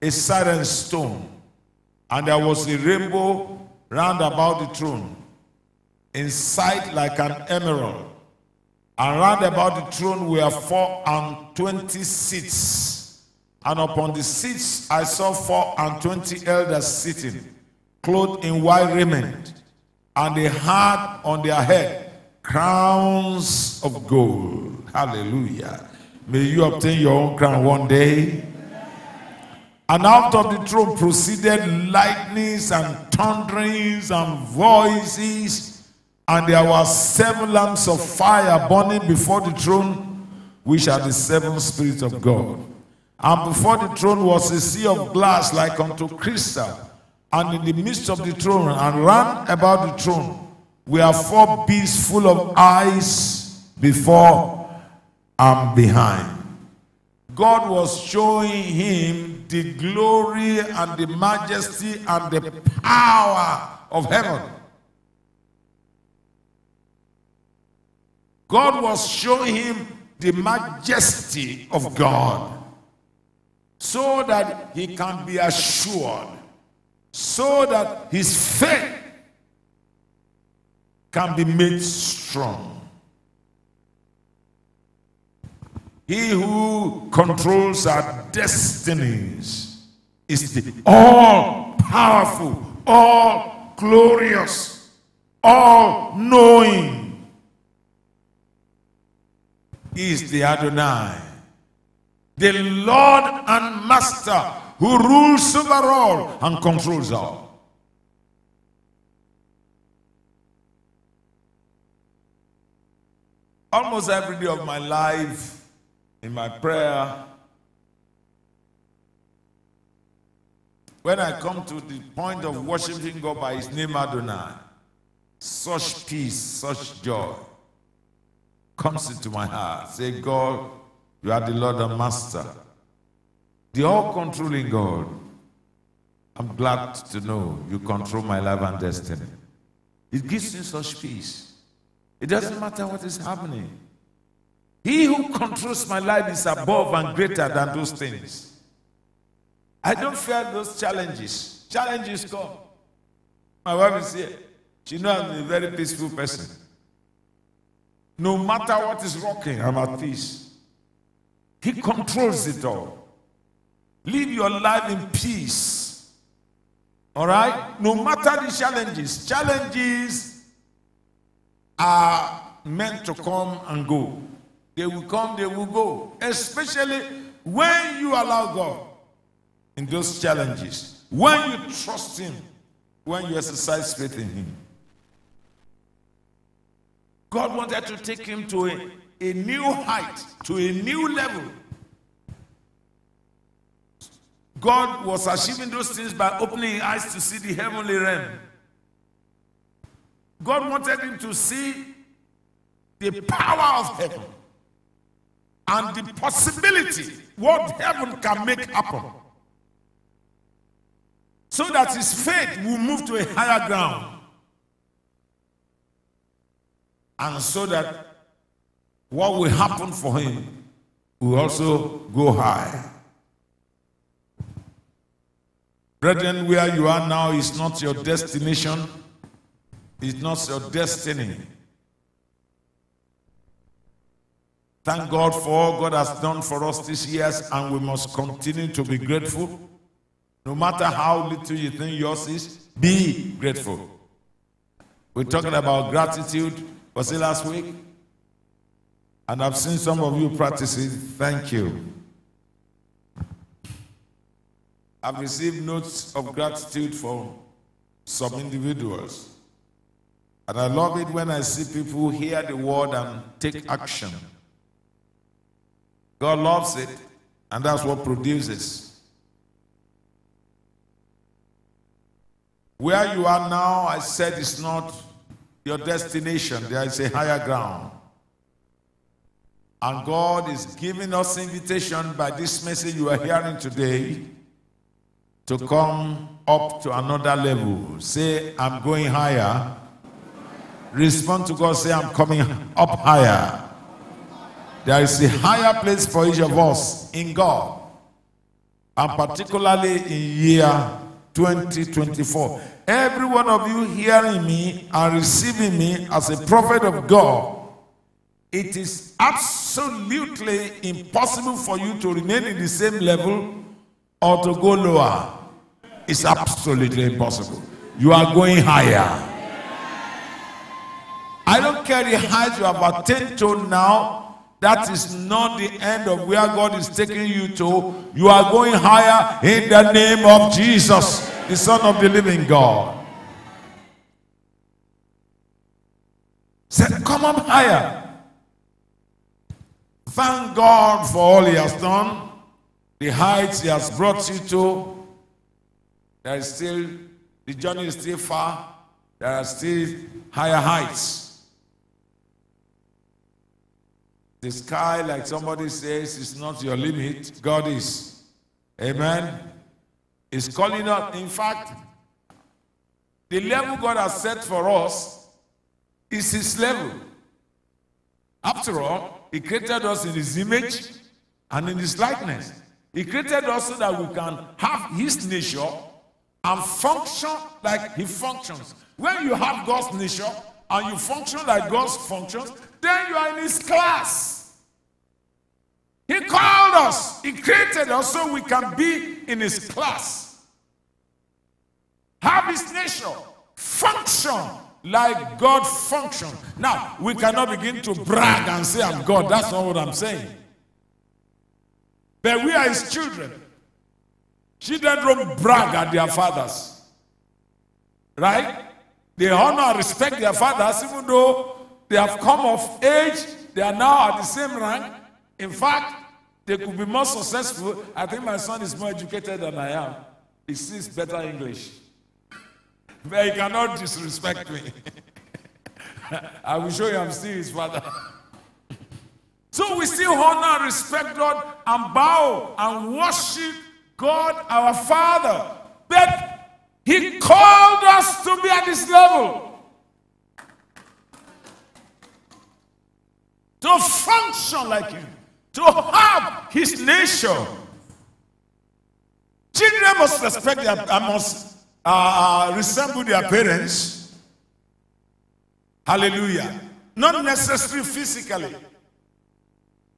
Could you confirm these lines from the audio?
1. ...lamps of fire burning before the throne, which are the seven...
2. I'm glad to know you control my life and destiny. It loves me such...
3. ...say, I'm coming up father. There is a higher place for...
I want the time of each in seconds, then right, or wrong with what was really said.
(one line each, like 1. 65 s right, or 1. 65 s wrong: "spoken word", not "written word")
1. 37 s right
2. 136 s wrong: "gives", not "loves"
3. 291 s wrong: "higher", not "father".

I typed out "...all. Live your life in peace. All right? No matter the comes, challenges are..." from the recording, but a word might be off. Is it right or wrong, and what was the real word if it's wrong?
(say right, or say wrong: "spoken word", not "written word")
wrong: "challenges", not "comes".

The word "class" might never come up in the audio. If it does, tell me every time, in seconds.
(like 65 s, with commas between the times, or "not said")
383 s, 389 s.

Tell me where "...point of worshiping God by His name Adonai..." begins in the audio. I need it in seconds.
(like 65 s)
122 s.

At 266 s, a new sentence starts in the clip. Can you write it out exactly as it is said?
God loves it, and that's what produces.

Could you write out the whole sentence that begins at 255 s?
I've received notes of gratitude from some individuals.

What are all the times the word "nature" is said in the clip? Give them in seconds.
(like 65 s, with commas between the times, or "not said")
375 s, 379 s, 392 s, 446 s.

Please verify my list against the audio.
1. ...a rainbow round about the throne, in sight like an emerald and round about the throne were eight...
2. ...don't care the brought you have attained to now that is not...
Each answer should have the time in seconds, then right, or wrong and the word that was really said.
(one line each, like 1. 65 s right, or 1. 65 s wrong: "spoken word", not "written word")
1. 2 s wrong: "four", not "eight"
2. 321 s wrong: "height", not "brought".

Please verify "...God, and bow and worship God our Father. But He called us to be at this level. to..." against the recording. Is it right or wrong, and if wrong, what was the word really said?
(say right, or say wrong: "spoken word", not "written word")
right.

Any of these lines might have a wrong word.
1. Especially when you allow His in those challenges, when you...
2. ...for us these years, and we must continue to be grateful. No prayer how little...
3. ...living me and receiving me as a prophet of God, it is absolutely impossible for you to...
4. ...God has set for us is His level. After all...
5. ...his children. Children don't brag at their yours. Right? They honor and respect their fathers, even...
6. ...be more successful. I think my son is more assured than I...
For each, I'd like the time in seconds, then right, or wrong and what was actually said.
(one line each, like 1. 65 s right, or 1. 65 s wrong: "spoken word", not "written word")
1. 176 s wrong: "God", not "His"
2. 236 s wrong: "matter", not "prayer"
3. 303 s wrong: "hearing", not "living"
4. 363 s right
5. 402 s wrong: "fathers", not "yours"
6. 416 s wrong: "educated", not "assured".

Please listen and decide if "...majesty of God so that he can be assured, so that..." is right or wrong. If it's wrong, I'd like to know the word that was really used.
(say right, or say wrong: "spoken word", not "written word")
right.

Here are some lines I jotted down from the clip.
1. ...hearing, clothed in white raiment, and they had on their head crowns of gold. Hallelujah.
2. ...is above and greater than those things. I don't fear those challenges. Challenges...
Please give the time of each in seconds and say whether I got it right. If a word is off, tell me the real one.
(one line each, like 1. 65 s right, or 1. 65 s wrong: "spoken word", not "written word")
1. 16 s wrong: "sitting", not "hearing"
2. 146 s right.